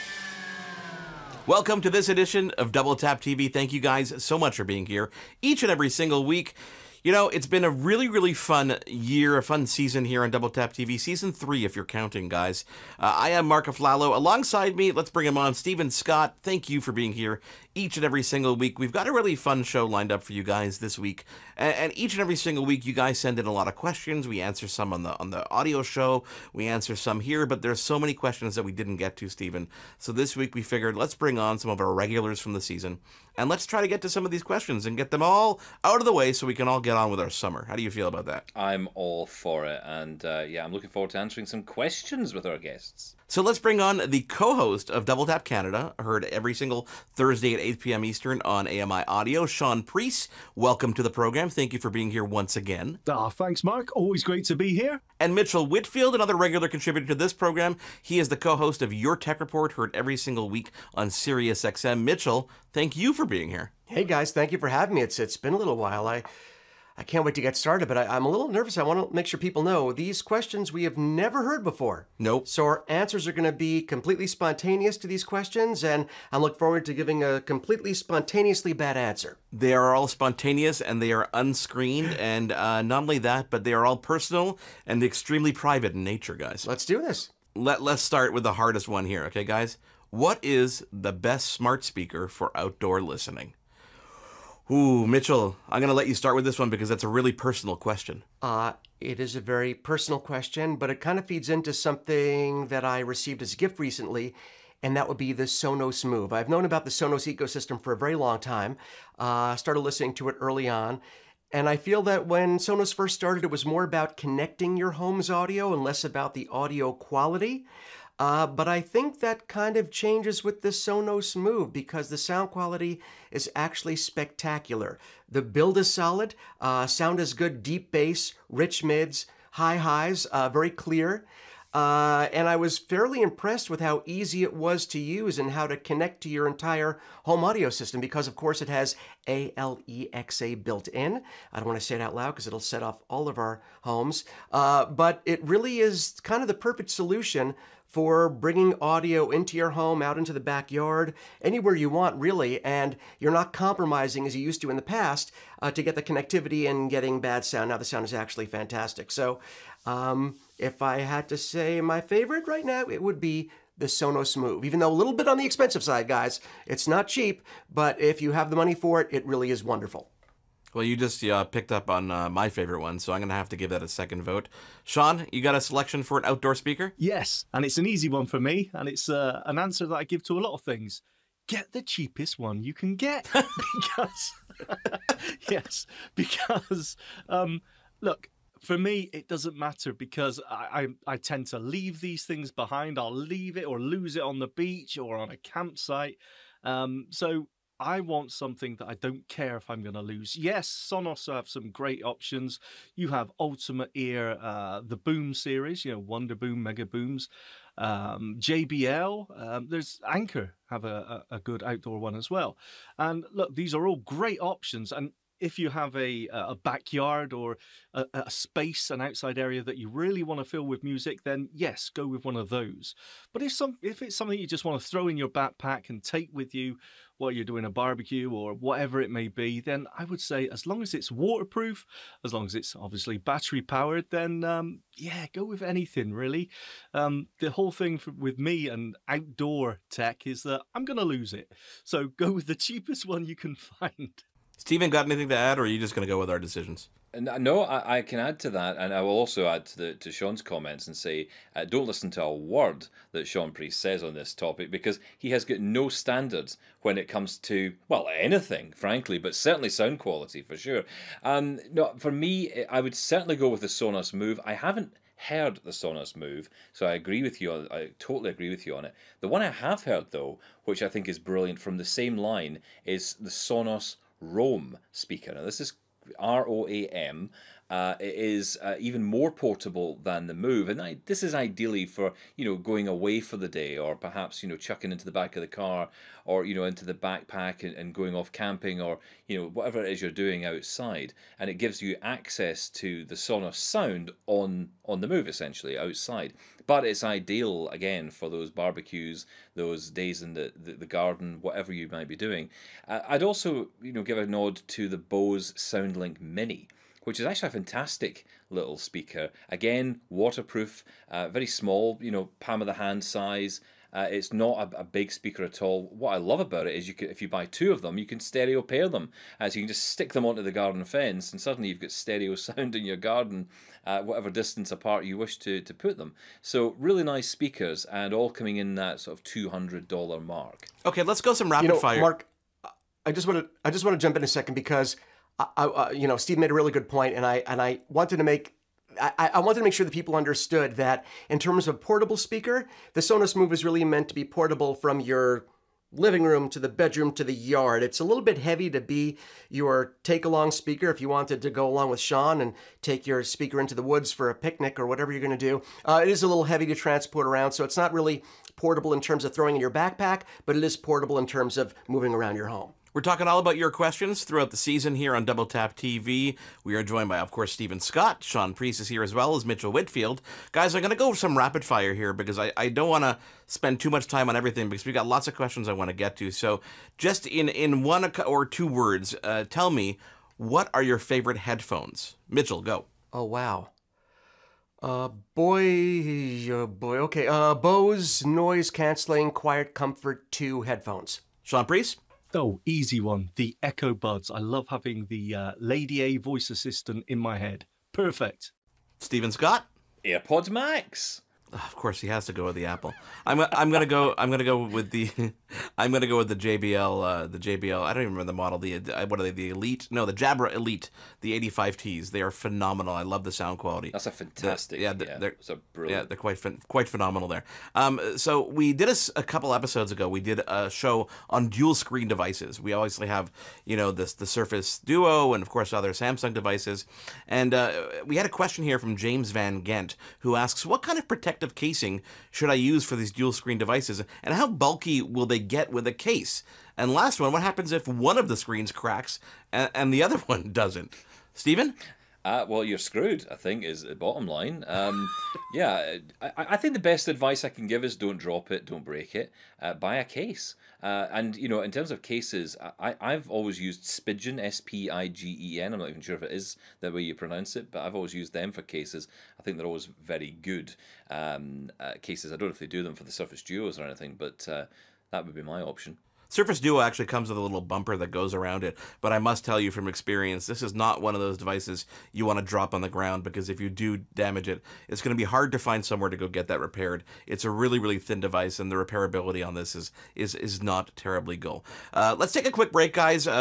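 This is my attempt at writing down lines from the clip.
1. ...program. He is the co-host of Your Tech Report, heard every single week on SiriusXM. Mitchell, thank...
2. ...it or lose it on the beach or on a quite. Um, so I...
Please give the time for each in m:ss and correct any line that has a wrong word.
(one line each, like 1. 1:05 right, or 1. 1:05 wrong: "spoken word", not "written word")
1. 0:57 right
2. 3:13 wrong: "campsite", not "quite".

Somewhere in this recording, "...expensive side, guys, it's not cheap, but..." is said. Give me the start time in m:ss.
2:45.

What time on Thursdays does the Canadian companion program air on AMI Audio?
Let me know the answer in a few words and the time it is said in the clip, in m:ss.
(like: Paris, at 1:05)
8 p.m. Eastern, at 0:47.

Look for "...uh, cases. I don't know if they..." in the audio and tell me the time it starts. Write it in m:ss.
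7:41.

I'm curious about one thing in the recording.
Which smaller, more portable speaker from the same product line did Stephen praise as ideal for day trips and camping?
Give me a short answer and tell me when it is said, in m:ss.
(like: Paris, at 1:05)
Sonos Roam, at 4:33.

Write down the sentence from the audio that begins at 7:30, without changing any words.
Uh, and, you know, in terms of cases, I, I've always used Spigen, S P I G E N.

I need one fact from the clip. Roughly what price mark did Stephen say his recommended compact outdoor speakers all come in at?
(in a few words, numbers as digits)
200 dollars.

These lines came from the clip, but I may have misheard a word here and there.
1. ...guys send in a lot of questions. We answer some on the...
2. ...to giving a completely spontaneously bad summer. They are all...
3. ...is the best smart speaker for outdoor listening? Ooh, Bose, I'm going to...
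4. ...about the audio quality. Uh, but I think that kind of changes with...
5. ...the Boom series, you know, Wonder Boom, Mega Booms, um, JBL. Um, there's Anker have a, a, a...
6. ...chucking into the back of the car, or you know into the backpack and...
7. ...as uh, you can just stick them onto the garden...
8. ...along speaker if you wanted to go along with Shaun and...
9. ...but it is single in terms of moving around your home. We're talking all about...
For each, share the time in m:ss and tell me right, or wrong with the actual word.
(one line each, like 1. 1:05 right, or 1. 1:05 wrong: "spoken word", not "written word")
1. 0:22 right
2. 1:16 wrong: "answer", not "summer"
3. 1:30 wrong: "Mitchell", not "Bose"
4. 1:56 right
5. 3:24 right
6. 4:44 right
7. 5:19 right
8. 5:50 right
9. 6:00 wrong: "portable", not "single".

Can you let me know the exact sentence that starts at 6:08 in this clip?
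Shaun Preece is here as well as Mitchell Whitfield.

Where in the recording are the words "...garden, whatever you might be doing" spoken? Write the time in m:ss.
5:00.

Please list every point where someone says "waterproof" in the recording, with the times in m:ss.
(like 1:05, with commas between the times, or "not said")
3:51, 5:10.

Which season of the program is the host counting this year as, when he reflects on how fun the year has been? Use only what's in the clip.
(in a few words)
3.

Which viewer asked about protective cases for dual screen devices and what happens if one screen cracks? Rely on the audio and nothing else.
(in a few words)
James Van Gent.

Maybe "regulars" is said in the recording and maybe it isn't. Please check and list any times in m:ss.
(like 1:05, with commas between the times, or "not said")
0:31, 0:56.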